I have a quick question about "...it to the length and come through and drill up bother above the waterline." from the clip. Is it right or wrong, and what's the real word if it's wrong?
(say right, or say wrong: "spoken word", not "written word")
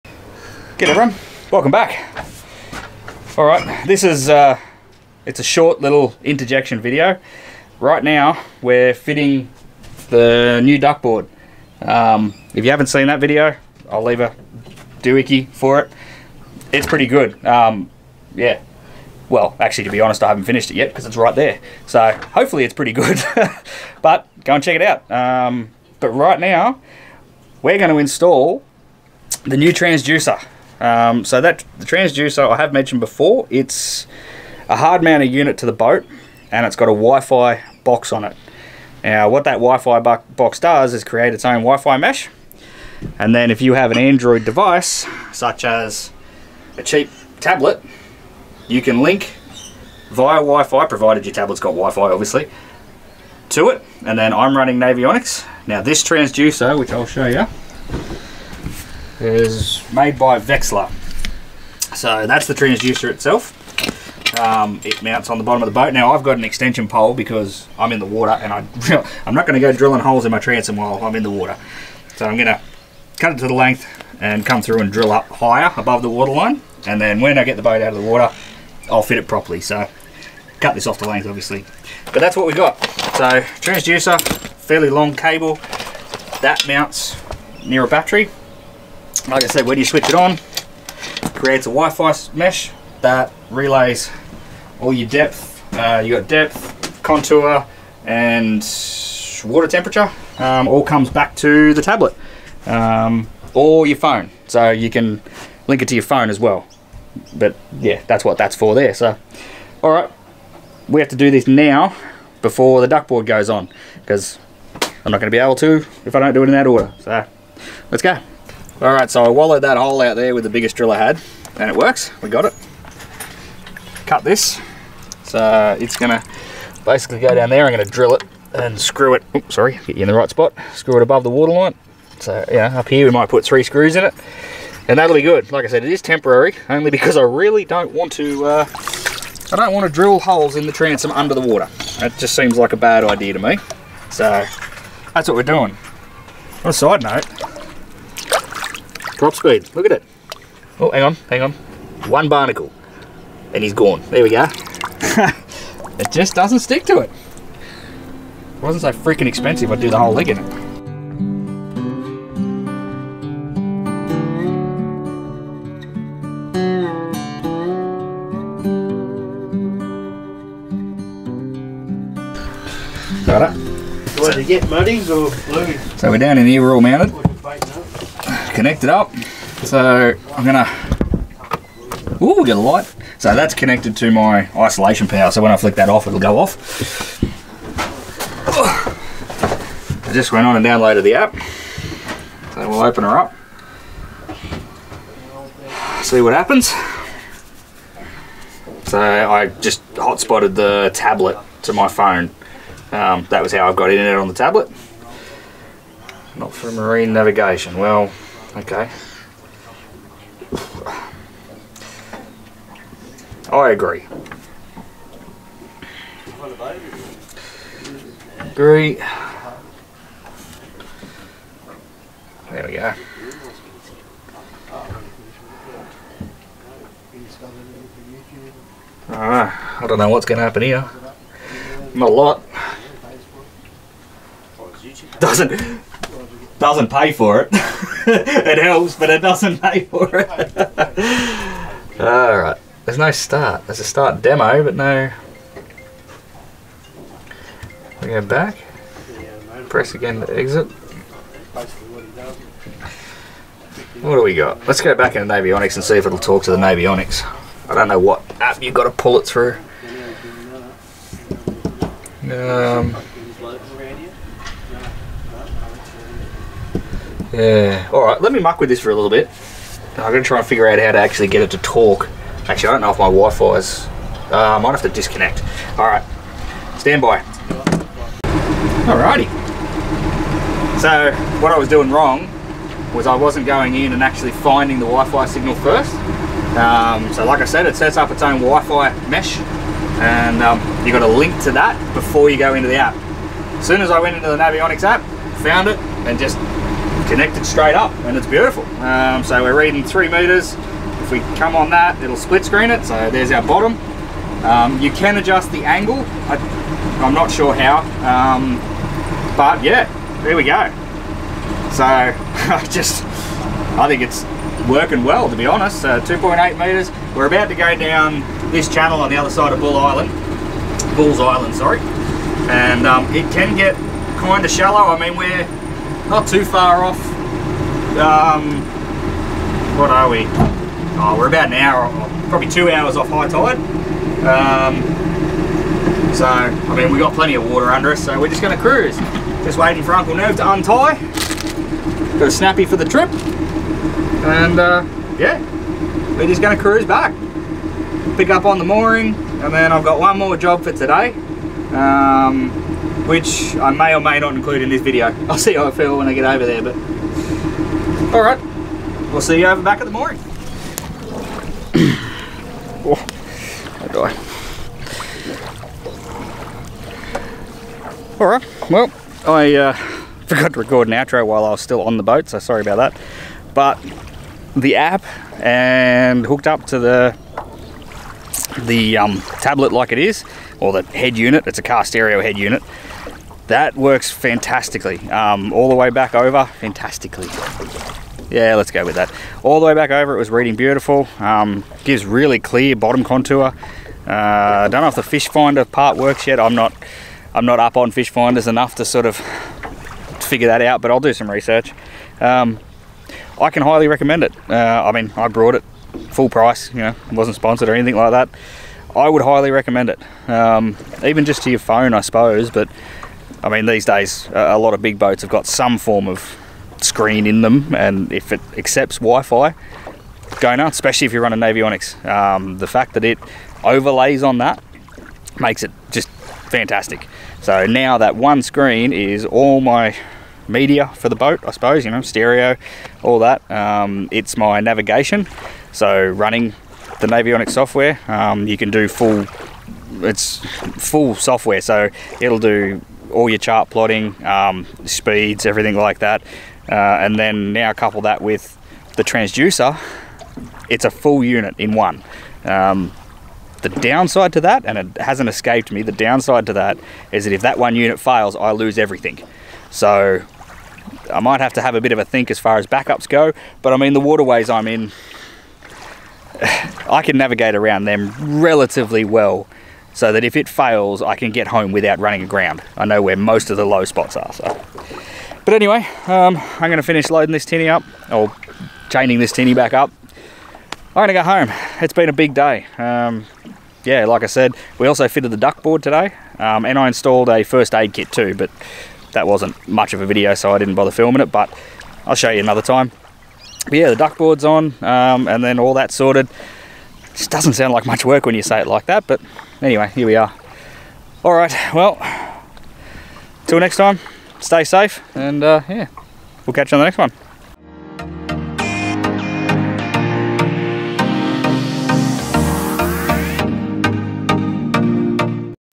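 wrong: "higher", not "bother".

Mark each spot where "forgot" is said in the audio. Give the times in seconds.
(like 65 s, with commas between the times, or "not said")
370 s.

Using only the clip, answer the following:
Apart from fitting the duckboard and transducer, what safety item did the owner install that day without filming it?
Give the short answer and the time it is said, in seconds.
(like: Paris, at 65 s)
First aid kit, at 487 s.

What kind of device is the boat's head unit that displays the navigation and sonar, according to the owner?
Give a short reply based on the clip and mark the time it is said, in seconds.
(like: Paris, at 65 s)
Car stereo head unit, at 381 s.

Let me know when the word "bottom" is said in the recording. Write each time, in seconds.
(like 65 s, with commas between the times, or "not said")
65 s, 303 s, 392 s.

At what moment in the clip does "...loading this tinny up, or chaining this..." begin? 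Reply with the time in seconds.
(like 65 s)
477 s.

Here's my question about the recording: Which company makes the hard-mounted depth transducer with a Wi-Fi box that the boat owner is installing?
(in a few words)
Vexilar.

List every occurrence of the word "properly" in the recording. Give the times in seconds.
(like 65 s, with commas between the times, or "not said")
79 s.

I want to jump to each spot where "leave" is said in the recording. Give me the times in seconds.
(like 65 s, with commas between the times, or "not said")
14 s.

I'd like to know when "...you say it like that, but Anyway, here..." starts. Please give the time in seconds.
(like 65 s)
498 s.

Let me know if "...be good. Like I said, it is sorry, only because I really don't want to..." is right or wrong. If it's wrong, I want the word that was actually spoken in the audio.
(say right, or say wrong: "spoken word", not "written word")
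wrong: "temporary", not "sorry".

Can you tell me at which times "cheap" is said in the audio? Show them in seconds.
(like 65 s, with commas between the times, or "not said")
46 s.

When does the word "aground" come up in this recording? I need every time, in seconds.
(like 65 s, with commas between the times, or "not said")
472 s.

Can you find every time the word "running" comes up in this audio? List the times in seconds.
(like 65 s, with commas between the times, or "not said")
54 s, 421 s, 436 s, 471 s.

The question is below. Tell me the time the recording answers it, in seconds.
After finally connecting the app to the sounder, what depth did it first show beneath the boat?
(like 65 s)
299 s.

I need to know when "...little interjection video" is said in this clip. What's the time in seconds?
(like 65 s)
5 s.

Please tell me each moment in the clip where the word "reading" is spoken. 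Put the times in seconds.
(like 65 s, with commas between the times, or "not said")
299 s, 390 s.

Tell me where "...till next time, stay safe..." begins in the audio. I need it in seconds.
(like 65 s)
503 s.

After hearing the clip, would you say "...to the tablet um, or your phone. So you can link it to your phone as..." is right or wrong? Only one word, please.
right.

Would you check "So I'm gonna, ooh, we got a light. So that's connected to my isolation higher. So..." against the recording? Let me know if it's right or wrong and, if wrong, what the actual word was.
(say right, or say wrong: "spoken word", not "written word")
wrong: "power", not "higher".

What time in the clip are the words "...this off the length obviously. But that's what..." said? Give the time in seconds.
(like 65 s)
80 s.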